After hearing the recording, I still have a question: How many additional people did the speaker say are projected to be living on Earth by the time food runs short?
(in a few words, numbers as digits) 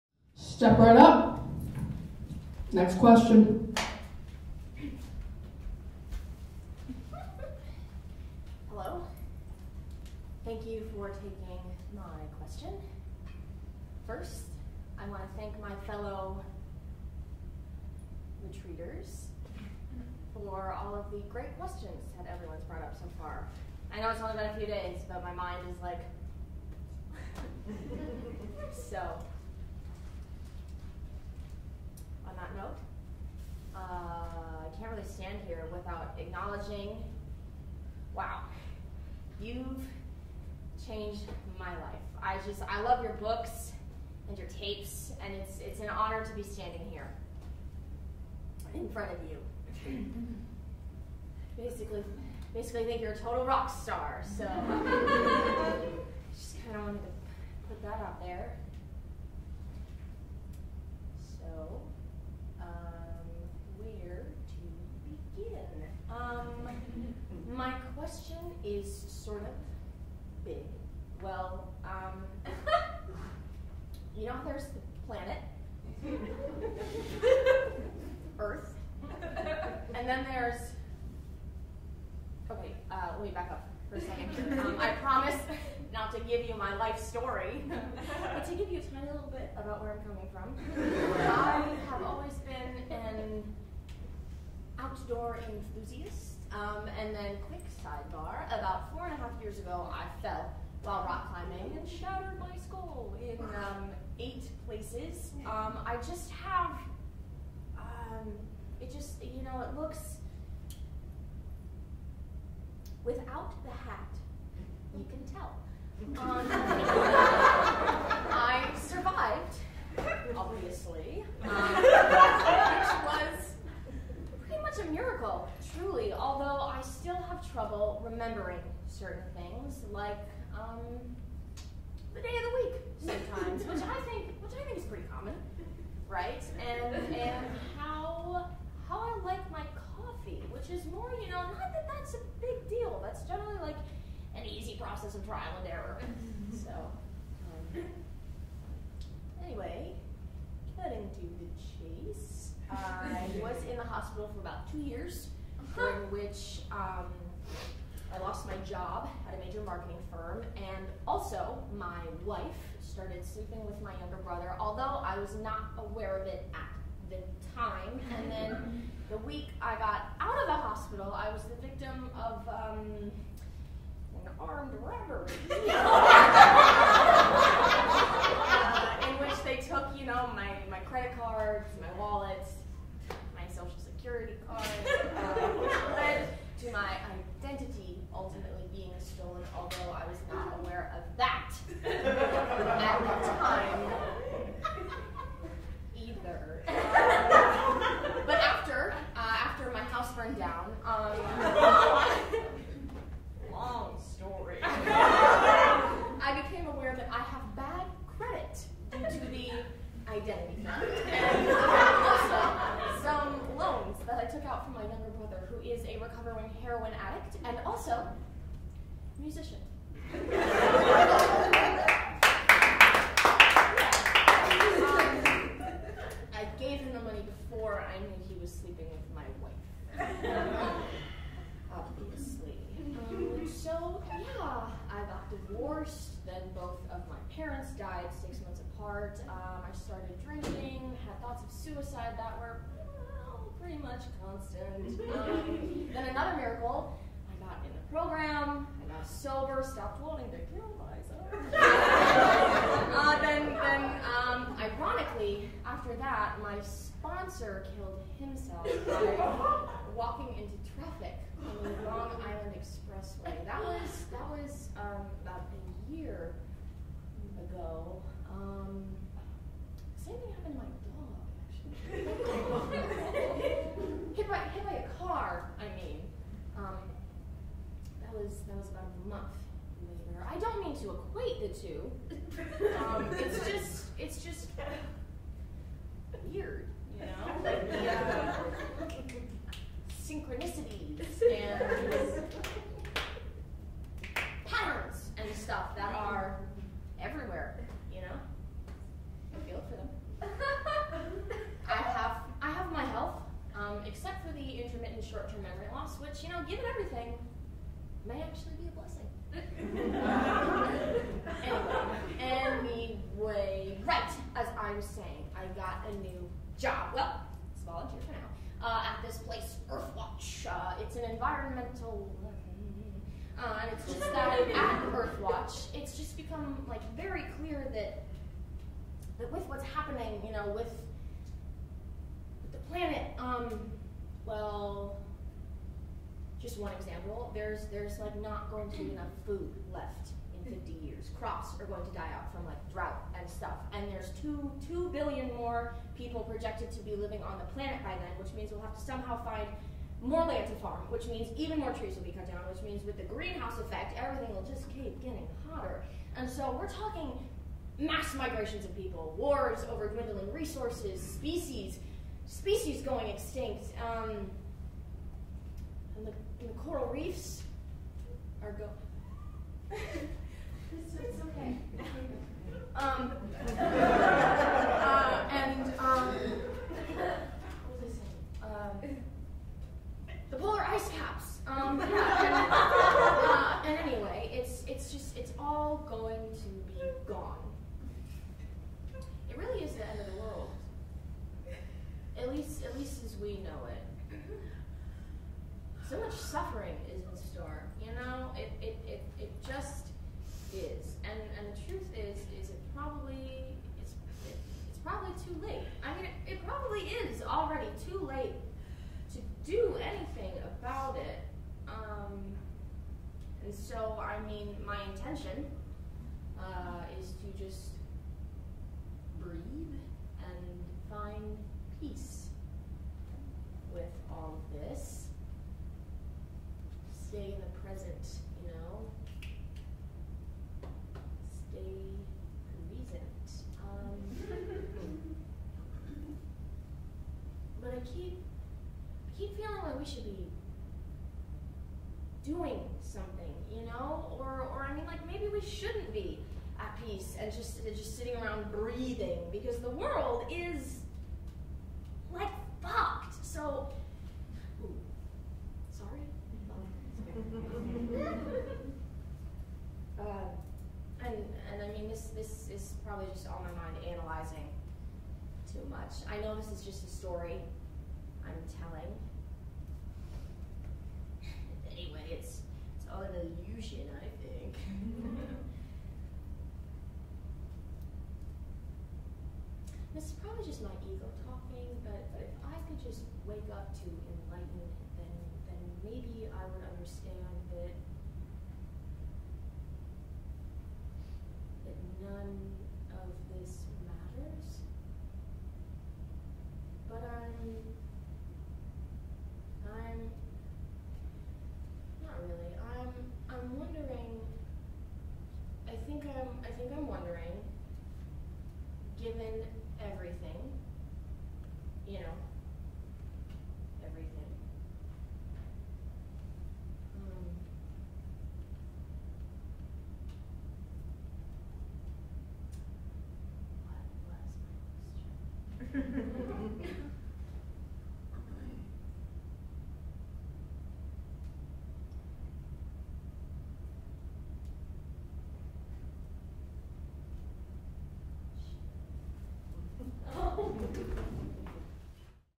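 2 billion.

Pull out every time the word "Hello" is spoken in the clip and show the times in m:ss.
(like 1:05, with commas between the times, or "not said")
0:08.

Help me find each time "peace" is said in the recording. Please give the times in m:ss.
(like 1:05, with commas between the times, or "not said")
7:01, 7:26.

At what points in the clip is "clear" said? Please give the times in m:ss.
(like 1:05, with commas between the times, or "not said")
5:27.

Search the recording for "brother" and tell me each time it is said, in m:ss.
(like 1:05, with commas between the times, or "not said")
2:44.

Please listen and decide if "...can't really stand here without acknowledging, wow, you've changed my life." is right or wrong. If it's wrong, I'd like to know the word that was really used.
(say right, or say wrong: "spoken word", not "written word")
right.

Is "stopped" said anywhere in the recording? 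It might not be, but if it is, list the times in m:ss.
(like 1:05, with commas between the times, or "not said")
4:09.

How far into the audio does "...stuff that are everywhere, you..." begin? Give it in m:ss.
4:55.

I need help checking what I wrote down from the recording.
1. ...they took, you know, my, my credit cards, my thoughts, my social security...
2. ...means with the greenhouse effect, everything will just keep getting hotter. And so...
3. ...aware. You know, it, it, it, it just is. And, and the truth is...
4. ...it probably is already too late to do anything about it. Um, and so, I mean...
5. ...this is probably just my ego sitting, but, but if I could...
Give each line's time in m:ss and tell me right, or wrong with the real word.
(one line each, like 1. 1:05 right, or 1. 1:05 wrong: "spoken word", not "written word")
1. 2:59 wrong: "wallets", not "thoughts"
2. 5:52 right
3. 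6:37 wrong: "store", not "aware"
4. 6:46 right
5. 7:59 wrong: "talking", not "sitting".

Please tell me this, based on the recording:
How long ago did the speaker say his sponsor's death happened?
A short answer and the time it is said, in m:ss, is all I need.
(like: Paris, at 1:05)
About a year ago, at 4:25.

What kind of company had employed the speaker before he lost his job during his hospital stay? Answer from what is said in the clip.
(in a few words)
Major marketing firm.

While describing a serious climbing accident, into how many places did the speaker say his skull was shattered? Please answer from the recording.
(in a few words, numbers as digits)
8.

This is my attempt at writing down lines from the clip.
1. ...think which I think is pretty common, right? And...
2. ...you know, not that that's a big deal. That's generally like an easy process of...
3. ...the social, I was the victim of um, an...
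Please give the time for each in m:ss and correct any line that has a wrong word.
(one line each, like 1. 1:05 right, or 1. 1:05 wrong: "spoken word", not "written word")
1. 2:14 right
2. 2:21 right
3. 2:50 wrong: "hospital", not "social".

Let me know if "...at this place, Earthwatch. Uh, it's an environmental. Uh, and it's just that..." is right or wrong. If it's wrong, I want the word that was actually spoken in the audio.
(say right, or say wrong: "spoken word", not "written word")
right.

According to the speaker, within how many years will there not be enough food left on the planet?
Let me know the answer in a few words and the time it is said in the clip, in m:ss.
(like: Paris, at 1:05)
50 years, at 5:40.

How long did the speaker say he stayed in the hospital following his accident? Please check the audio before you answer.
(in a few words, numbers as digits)
About two years.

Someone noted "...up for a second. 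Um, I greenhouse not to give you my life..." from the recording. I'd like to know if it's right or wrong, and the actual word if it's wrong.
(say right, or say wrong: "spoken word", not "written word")
wrong: "promise", not "greenhouse".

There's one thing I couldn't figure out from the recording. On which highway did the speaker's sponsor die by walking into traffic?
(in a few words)
Long Island Expressway.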